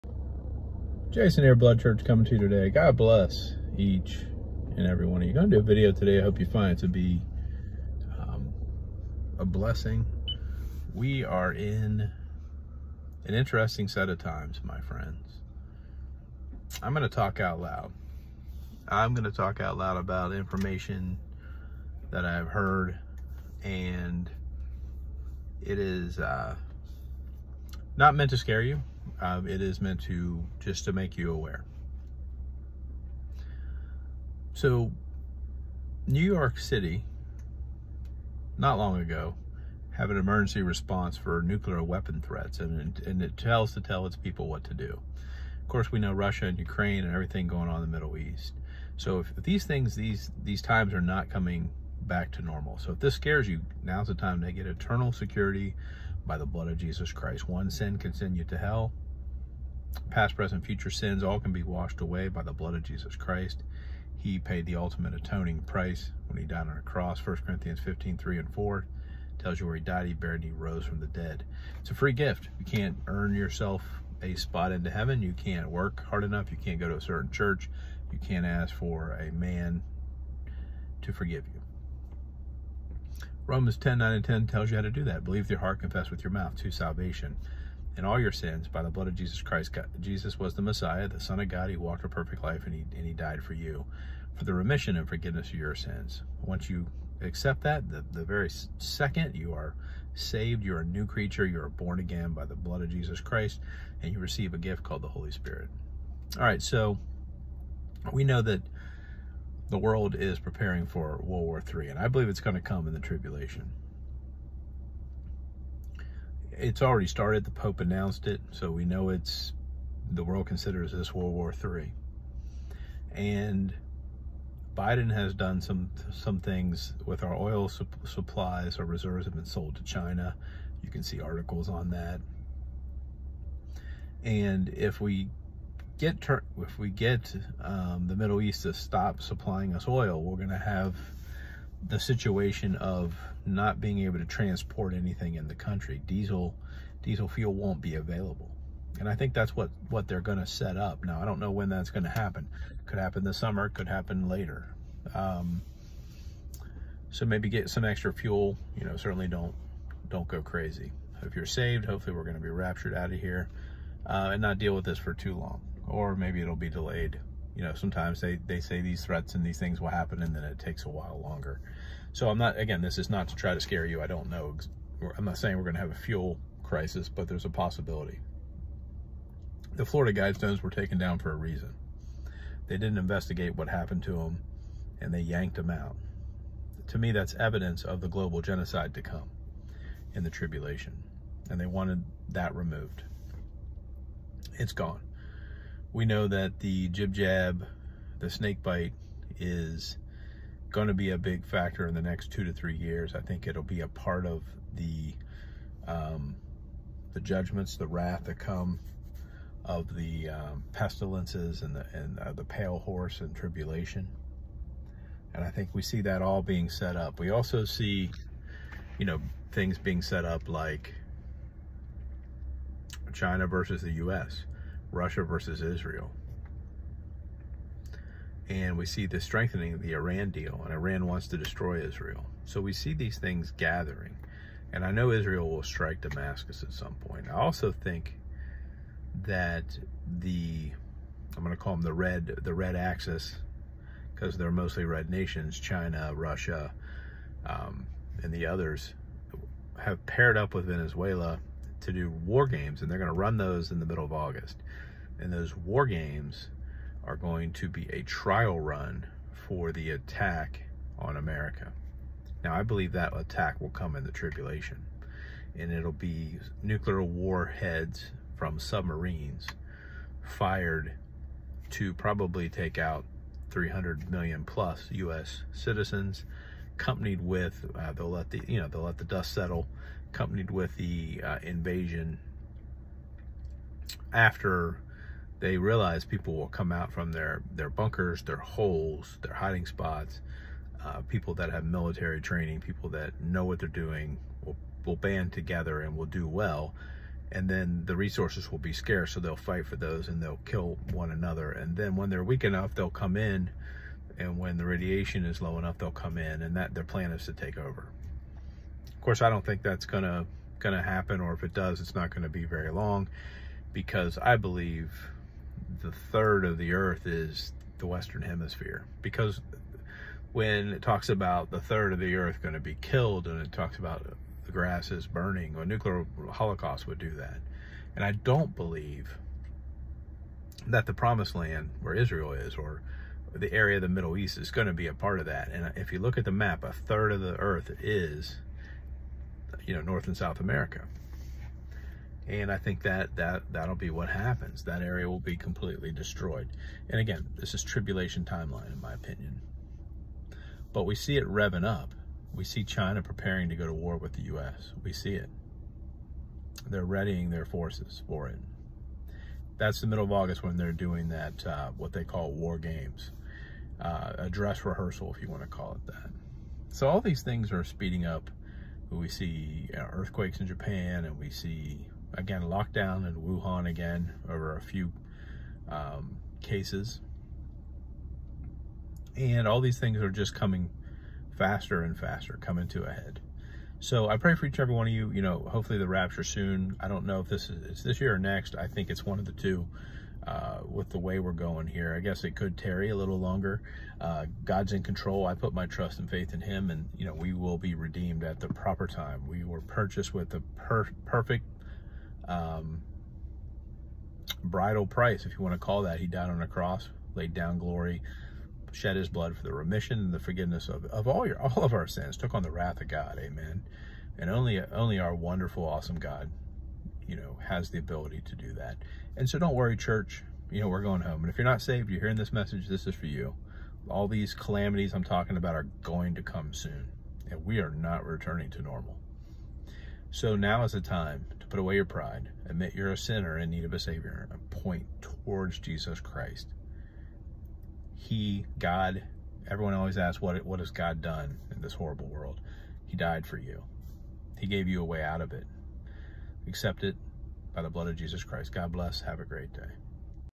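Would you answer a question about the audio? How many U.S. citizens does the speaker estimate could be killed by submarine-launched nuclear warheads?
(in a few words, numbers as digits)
300 million.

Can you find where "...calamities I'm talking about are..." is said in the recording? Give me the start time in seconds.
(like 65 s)
424 s.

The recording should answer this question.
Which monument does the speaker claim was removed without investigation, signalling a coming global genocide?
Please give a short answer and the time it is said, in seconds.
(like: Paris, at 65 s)
Florida Guidestones, at 179 s.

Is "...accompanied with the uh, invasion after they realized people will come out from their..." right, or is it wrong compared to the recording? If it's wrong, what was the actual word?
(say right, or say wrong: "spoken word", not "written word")
right.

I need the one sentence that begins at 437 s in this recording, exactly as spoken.
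He, God, everyone always asks, what, what has God done in this horrible world?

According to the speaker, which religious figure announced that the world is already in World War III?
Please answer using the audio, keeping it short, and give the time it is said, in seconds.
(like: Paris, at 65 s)
The Pope, at 117 s.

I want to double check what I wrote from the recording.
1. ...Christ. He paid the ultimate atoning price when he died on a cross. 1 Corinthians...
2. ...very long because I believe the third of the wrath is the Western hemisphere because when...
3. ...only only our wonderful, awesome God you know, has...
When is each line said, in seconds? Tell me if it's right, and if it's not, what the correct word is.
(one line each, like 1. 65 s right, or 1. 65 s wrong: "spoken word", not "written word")
1. 63 s right
2. 312 s wrong: "earth", not "wrath"
3. 414 s right.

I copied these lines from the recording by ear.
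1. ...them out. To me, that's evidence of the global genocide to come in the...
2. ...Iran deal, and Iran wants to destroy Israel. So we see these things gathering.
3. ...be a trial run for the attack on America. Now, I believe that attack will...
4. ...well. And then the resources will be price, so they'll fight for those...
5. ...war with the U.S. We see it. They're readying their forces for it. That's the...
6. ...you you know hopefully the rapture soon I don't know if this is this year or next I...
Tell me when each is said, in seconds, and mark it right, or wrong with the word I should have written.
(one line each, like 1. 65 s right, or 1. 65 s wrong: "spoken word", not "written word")
1. 185 s right
2. 229 s right
3. 257 s right
4. 296 s wrong: "scarce", not "price"
5. 353 s right
6. 384 s right.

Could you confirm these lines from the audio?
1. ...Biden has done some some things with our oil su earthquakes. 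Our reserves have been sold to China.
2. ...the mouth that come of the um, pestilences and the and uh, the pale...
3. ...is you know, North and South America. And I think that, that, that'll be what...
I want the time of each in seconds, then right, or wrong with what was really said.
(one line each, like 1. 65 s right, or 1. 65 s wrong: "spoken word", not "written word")
1. 124 s wrong: "supplies", not "earthquakes"
2. 207 s wrong: "wrath", not "mouth"
3. 337 s right.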